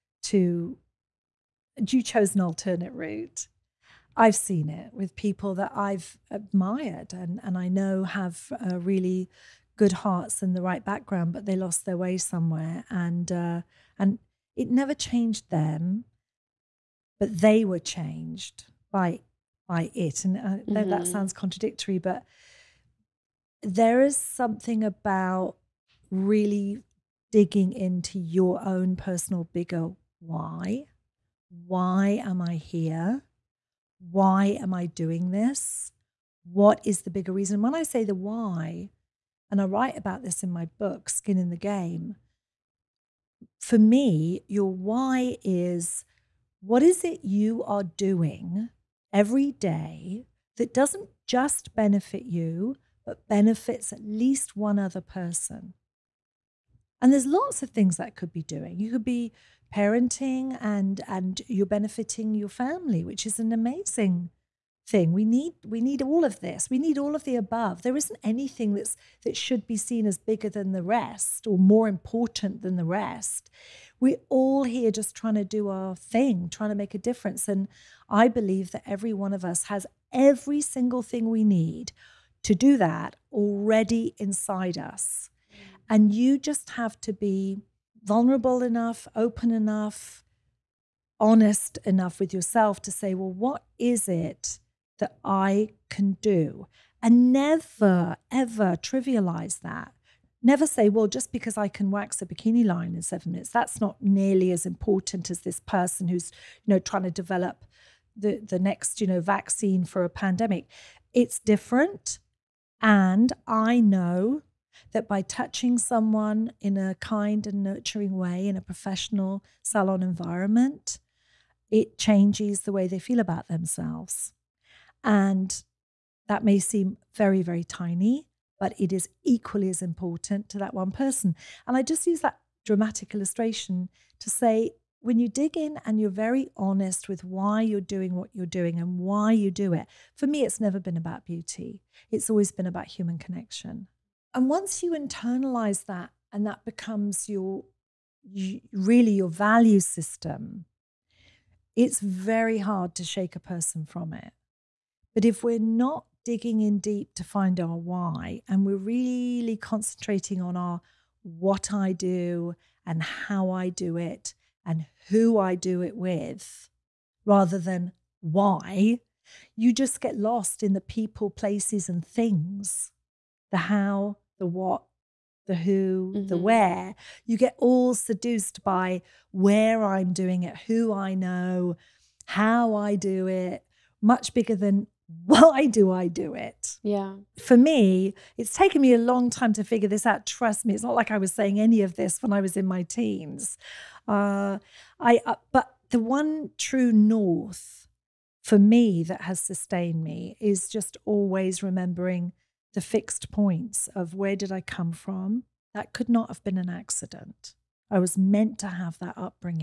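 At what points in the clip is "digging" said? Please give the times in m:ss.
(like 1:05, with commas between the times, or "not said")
0:27, 2:36.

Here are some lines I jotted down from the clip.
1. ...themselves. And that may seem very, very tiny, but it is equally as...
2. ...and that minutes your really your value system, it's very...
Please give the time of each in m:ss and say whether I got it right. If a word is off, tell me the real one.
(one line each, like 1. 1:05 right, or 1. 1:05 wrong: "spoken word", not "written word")
1. 2:03 right
2. 2:26 wrong: "becomes", not "minutes".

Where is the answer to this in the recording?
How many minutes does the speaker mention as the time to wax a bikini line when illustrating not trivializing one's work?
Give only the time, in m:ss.
1:43.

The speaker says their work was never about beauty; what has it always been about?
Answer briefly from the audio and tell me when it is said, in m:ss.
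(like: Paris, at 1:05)
Human connection, at 2:22.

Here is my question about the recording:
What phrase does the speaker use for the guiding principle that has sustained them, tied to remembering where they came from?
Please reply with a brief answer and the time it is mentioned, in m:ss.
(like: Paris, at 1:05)
True north, at 3:16.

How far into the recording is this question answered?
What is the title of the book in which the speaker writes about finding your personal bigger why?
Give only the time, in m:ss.
0:41.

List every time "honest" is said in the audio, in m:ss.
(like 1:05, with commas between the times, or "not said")
1:31, 2:16.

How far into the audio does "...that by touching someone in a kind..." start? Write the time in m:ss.
1:54.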